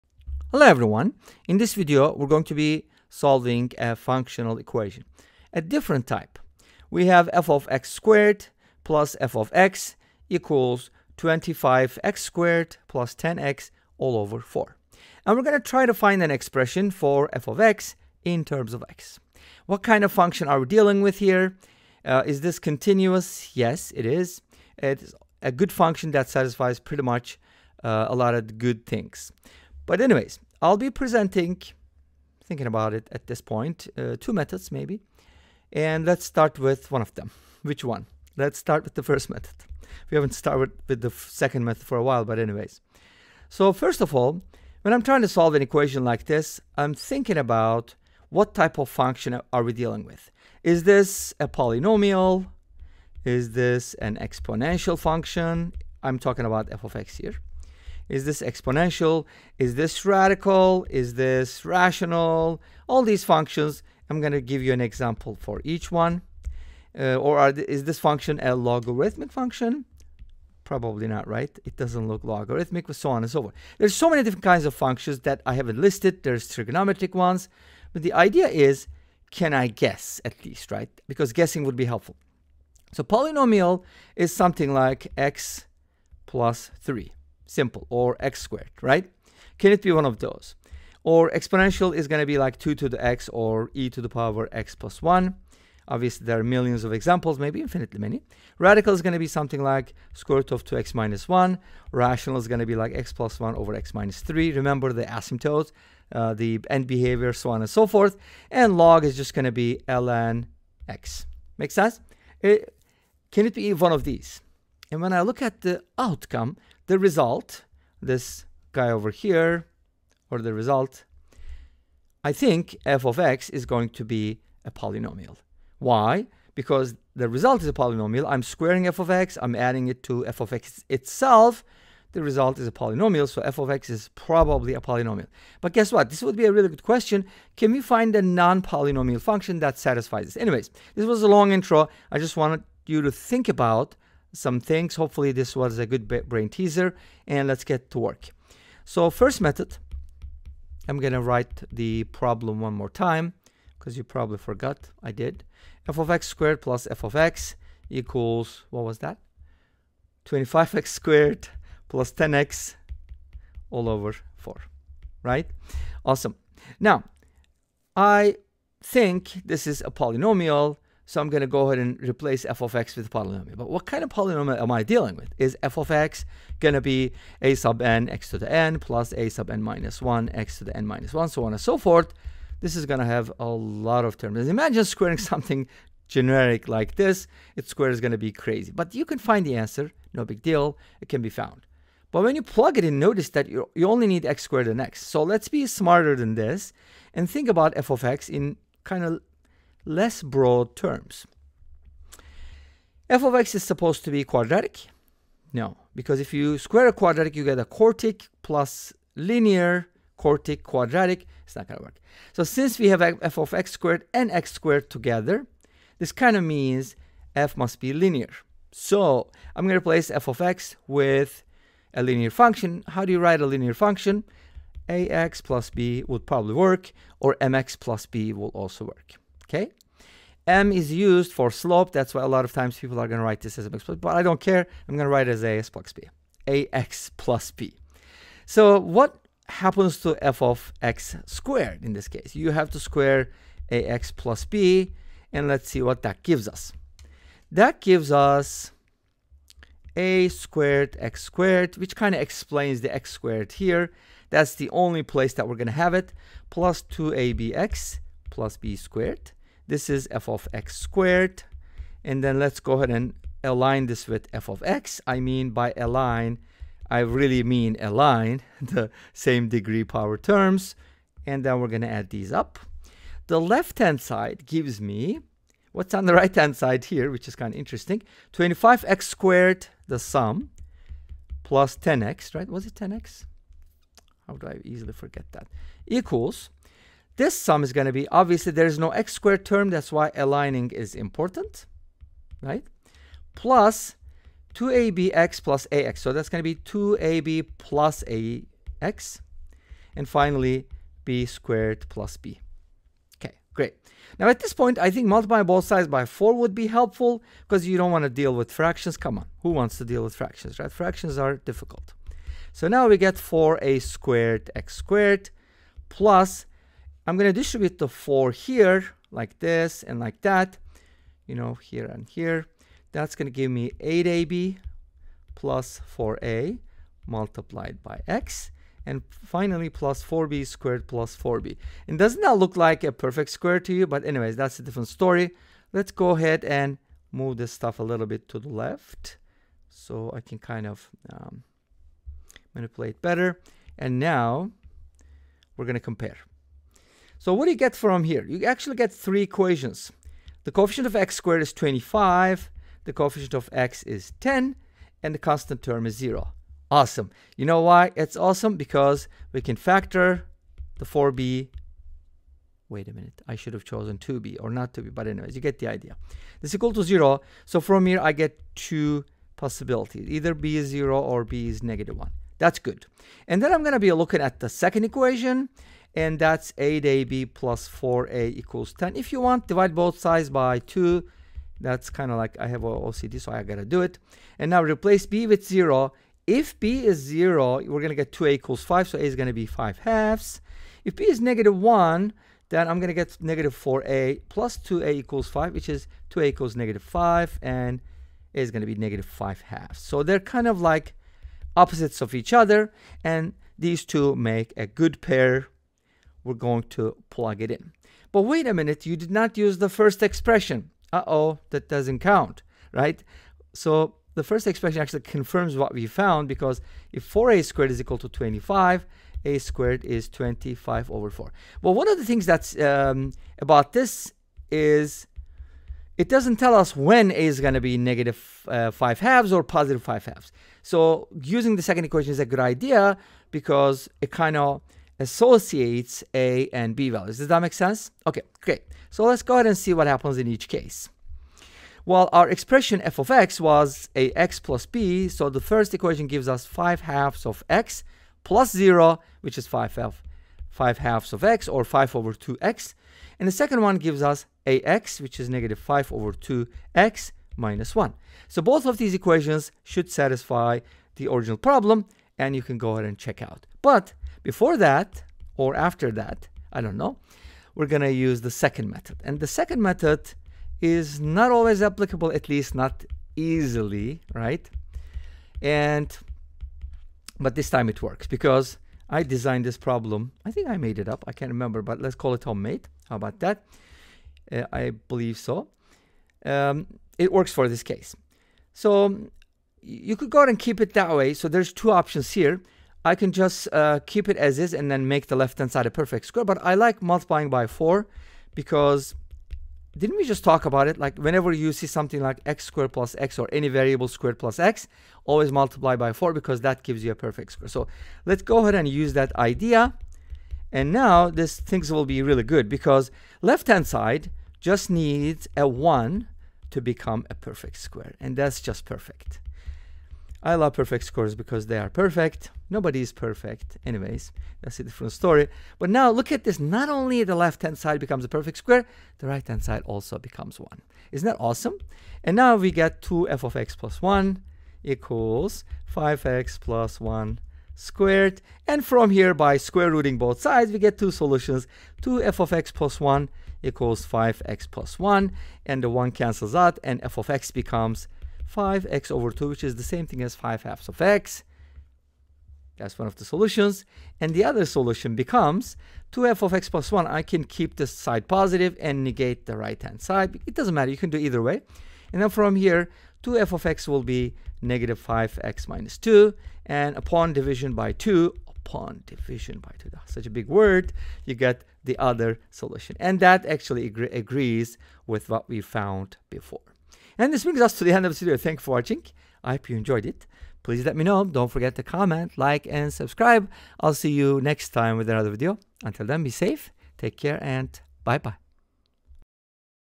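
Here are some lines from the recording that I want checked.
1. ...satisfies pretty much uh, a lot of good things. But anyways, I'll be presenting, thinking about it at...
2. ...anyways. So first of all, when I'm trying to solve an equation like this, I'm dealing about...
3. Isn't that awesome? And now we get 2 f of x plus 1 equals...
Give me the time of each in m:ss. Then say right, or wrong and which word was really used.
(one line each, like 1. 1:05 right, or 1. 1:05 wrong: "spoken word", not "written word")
1. 0:26 right
2. 0:42 wrong: "thinking", not "dealing"
3. 8:50 right.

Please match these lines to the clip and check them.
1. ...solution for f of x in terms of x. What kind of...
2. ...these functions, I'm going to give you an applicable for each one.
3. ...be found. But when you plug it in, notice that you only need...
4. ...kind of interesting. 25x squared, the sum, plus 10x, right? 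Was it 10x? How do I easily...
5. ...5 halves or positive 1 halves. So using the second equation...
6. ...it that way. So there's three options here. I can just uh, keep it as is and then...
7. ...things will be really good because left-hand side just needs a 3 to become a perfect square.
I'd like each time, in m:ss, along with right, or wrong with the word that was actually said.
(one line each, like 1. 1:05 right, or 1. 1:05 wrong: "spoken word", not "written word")
1. 0:16 wrong: "expression", not "solution"
2. 1:03 wrong: "example", not "applicable"
3. 3:11 right
4. 4:37 right
5. 7:08 wrong: "5", not "1"
6. 8:10 wrong: "two", not "three"
7. 8:31 wrong: "1", not "3".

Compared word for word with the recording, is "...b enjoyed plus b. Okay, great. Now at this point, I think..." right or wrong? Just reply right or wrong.
wrong.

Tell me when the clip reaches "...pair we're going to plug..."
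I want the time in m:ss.
6:45.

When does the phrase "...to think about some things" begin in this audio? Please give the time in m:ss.
2:23.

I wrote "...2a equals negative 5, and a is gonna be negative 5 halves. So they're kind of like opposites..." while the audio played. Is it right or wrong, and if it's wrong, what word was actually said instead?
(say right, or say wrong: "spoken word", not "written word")
right.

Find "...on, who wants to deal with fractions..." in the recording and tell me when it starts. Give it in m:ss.
5:09.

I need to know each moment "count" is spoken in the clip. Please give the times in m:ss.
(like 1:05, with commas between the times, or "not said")
6:51.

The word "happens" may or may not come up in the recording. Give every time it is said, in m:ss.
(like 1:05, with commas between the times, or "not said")
3:59, 7:19.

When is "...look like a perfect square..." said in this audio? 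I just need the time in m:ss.
5:32.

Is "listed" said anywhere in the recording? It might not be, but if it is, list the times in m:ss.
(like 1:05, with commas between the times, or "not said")
1:15.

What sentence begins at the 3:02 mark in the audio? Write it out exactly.
This is going to have a lot of terms.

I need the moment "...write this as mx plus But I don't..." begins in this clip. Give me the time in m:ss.
3:53.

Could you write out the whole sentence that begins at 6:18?
If you want, divide both sides by 2.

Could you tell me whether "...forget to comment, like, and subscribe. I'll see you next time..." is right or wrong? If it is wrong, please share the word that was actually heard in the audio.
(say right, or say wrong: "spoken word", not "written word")
right.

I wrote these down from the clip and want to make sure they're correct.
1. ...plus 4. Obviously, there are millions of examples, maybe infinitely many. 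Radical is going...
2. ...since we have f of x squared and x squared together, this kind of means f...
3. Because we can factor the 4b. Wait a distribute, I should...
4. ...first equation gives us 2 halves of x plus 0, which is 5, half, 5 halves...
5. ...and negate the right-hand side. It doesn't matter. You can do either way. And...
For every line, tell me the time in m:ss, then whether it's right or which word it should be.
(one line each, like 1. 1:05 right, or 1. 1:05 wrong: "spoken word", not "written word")
1. 1:34 wrong: "1", not "4"
2. 3:32 right
3. 5:58 wrong: "minute", not "distribute"
4. 7:25 wrong: "5", not "2"
5. 9:18 right.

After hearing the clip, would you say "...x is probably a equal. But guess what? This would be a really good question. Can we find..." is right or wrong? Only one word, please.
wrong.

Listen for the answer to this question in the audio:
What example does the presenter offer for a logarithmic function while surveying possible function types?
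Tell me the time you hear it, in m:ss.
1:49.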